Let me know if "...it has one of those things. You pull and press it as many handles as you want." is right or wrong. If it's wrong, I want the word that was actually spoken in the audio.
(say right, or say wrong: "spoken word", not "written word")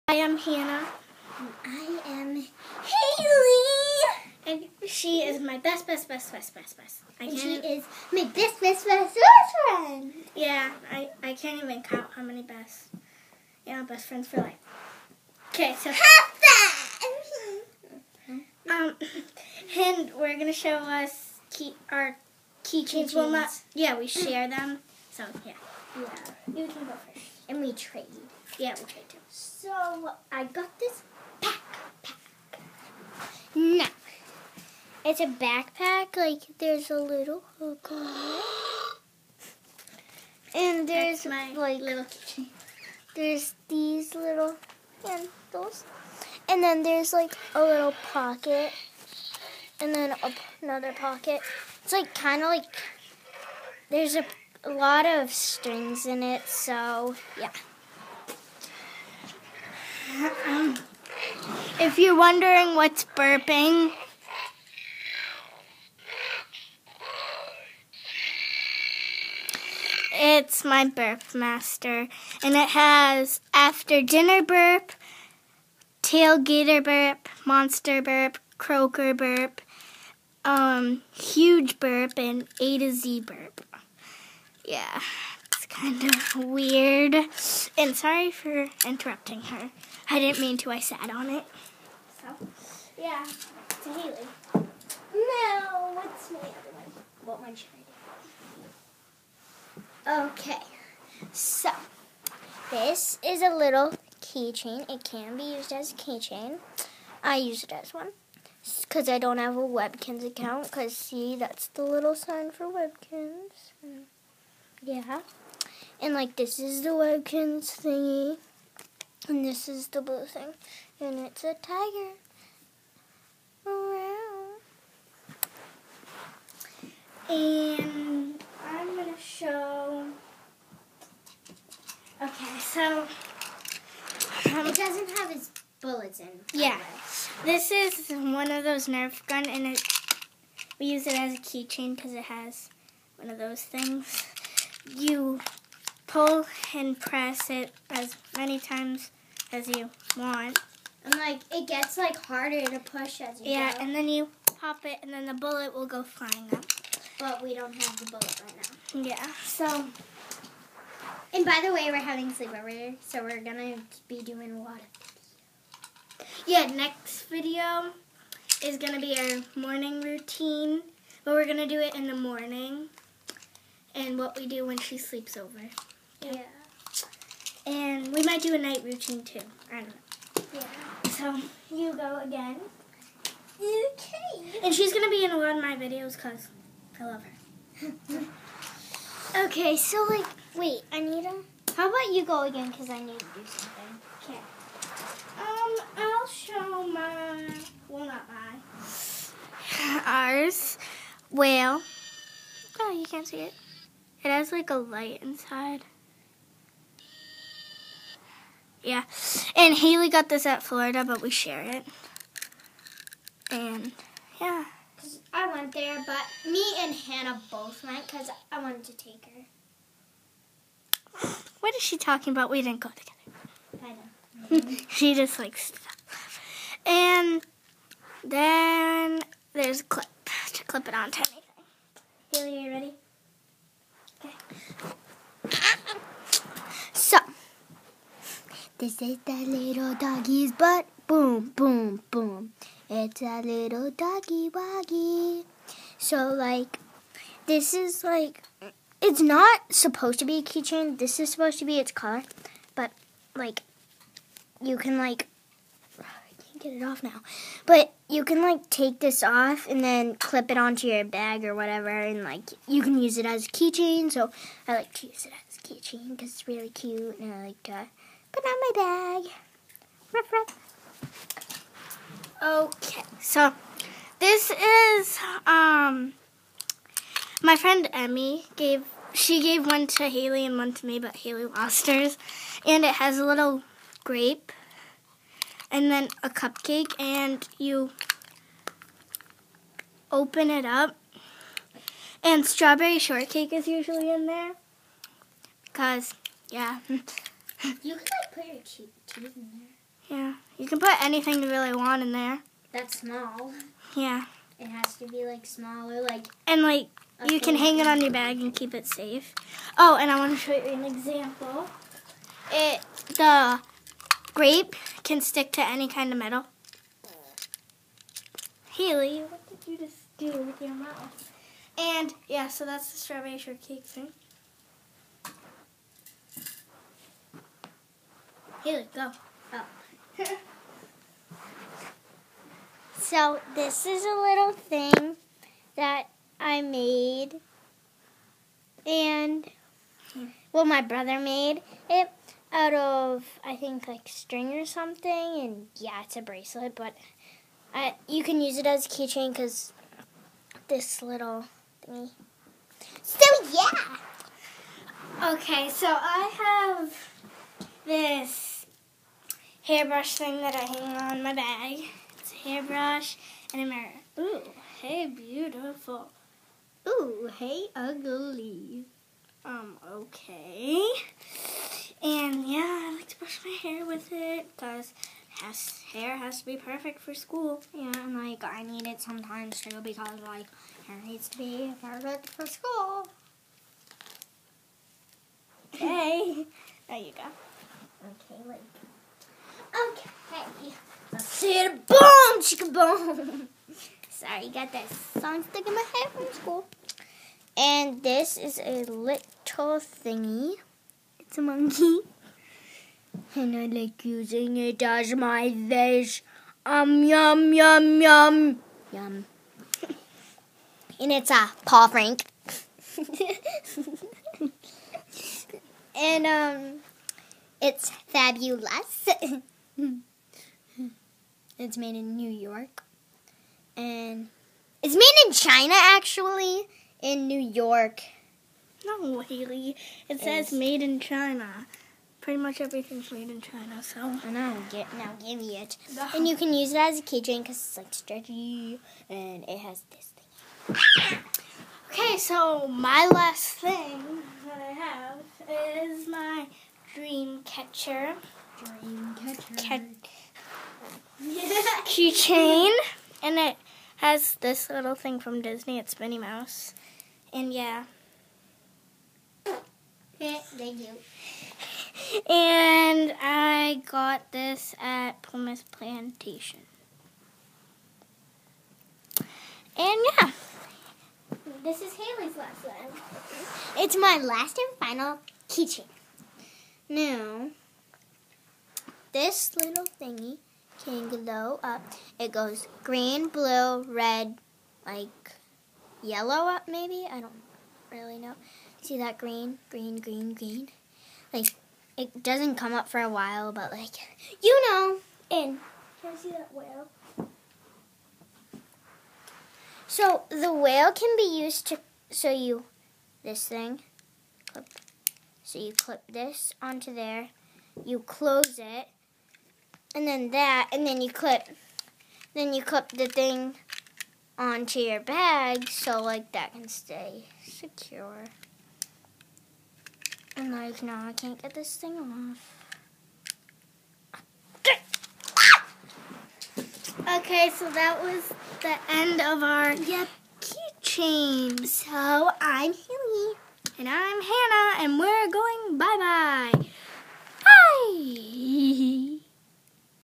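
wrong: "times", not "handles".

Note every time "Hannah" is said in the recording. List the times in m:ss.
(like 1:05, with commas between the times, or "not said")
0:00, 3:36, 8:54.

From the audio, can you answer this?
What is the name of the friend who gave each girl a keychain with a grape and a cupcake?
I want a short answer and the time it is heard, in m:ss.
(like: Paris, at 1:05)
Emmy, at 4:37.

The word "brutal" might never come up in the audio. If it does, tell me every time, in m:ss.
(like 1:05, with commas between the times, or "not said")
not said.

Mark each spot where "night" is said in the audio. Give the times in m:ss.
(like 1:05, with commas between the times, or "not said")
2:58.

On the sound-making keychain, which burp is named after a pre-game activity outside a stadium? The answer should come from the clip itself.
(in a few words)
Tailgater burp.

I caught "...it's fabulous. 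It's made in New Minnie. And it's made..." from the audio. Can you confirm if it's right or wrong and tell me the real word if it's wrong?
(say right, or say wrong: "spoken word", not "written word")
wrong: "York", not "Minnie".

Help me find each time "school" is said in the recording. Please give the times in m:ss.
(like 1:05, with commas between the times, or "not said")
6:17, 6:22, 6:36.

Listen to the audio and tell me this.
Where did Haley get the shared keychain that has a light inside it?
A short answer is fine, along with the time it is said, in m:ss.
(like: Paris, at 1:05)
Florida, at 3:30.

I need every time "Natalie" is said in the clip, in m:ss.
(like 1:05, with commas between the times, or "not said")
not said.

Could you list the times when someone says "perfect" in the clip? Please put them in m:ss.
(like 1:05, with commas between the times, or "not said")
6:16, 6:21.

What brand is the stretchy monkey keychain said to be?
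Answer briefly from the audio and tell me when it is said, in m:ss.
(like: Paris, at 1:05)
Paul Frank, at 6:51.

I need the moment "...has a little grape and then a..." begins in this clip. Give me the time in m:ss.
4:42.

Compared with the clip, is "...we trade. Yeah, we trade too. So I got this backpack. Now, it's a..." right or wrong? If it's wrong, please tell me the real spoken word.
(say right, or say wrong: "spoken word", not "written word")
right.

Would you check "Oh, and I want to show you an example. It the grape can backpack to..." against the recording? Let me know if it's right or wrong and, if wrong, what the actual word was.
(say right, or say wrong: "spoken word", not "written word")
wrong: "stick", not "backpack".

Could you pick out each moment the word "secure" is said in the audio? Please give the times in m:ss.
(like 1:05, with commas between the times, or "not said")
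8:37.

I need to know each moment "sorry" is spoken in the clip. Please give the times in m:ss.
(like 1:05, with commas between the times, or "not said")
1:27, 6:34.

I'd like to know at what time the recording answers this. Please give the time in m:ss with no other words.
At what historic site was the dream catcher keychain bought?
7:45.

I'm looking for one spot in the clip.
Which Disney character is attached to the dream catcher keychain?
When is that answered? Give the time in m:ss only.
7:35.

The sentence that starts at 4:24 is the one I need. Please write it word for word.
So, I like to use it as a keychain because it's really cute and I like to.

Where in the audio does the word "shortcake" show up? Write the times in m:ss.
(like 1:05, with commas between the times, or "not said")
4:52, 5:23.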